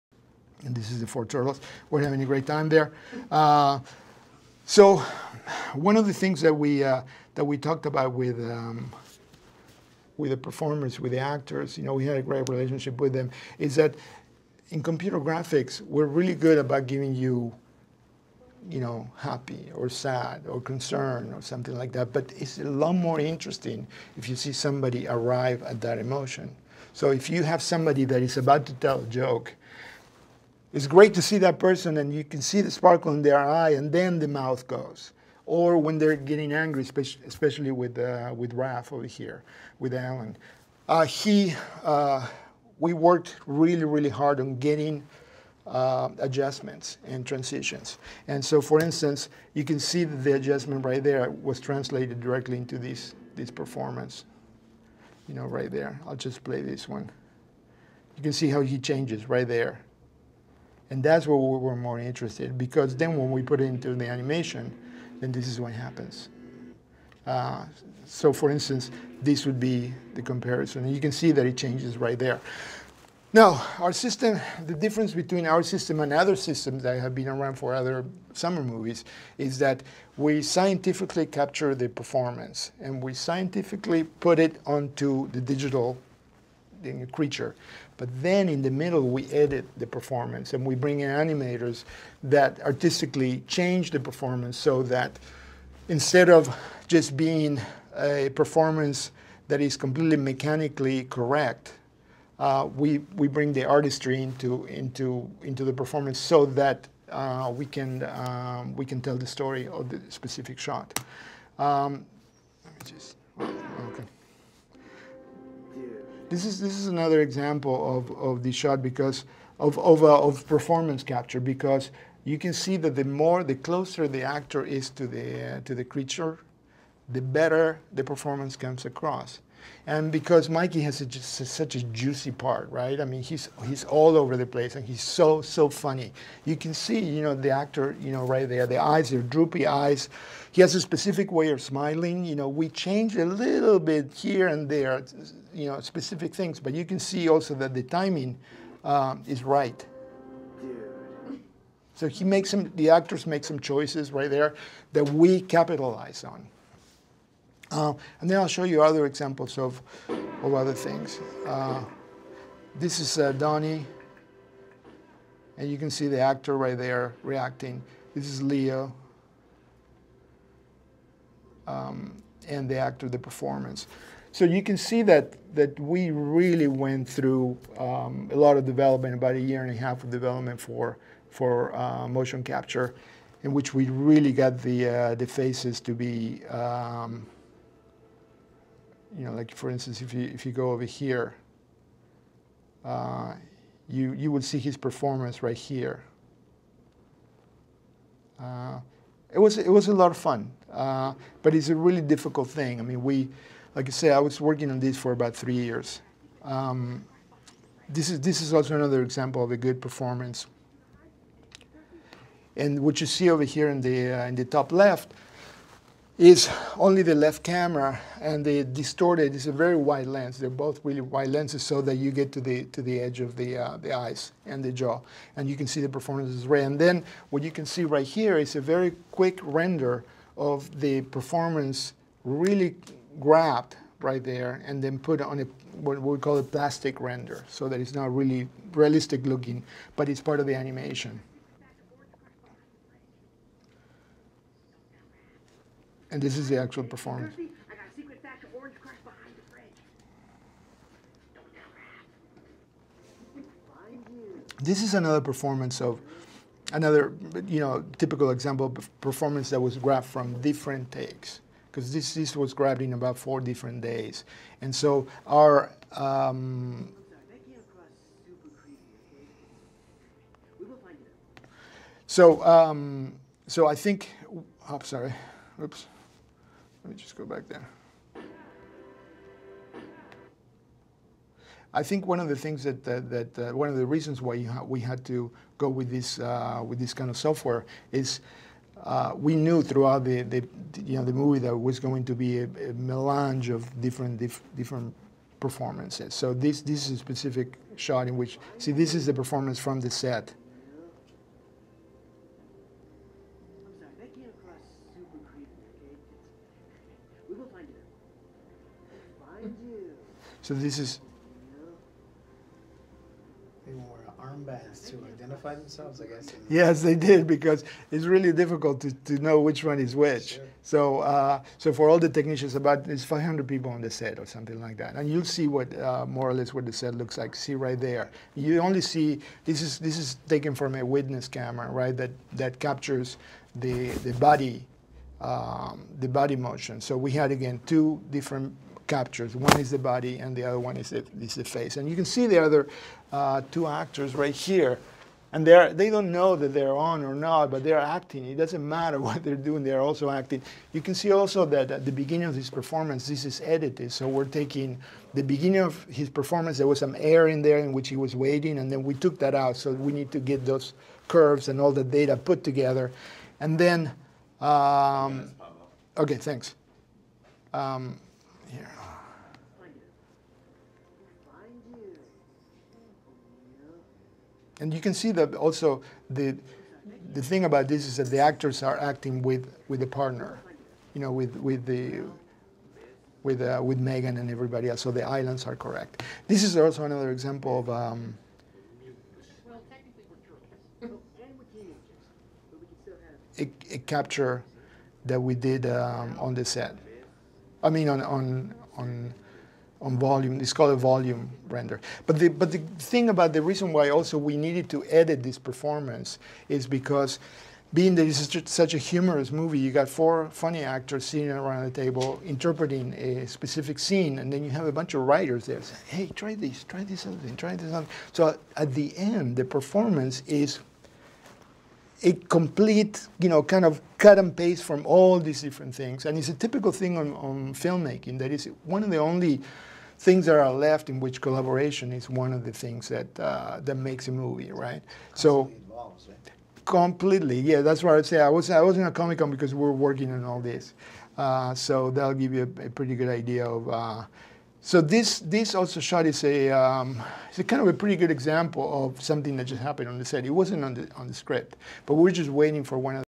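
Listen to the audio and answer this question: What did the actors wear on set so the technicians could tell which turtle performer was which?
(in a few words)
armbands.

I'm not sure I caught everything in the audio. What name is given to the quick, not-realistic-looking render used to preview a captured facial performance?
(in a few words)
plastic render.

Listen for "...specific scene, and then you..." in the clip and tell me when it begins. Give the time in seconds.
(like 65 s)
413 s.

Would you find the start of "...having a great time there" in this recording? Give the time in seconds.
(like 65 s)
2 s.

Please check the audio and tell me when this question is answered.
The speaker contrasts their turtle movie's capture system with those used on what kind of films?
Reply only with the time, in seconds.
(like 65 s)
78 s.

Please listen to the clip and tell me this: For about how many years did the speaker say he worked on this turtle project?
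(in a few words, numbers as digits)
3.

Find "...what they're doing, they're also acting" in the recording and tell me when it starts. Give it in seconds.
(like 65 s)
349 s.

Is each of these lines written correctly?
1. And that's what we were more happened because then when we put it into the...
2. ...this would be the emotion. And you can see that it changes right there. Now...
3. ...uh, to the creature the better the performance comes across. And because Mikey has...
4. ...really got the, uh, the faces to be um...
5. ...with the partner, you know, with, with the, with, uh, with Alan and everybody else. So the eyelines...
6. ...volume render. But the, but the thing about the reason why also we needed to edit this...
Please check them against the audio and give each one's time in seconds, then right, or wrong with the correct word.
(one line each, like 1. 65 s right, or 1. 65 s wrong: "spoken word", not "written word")
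1. 60 s wrong: "interested", not "happened"
2. 69 s wrong: "comparison", not "emotion"
3. 125 s right
4. 183 s right
5. 379 s wrong: "Megan", not "Alan"
6. 400 s right.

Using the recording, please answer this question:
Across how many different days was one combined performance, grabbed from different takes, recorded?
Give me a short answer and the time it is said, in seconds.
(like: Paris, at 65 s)
4, at 262 s.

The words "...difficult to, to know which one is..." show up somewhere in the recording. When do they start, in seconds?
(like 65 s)
318 s.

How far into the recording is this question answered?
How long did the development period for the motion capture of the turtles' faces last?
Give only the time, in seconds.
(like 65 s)
179 s.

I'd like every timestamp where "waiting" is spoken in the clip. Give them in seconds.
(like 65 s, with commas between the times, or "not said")
358 s, 452 s.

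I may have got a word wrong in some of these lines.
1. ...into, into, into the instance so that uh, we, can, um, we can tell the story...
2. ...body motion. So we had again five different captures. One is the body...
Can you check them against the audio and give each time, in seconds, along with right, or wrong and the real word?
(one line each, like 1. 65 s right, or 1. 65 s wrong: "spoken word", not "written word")
1. 104 s wrong: "performance", not "instance"
2. 336 s wrong: "two", not "five".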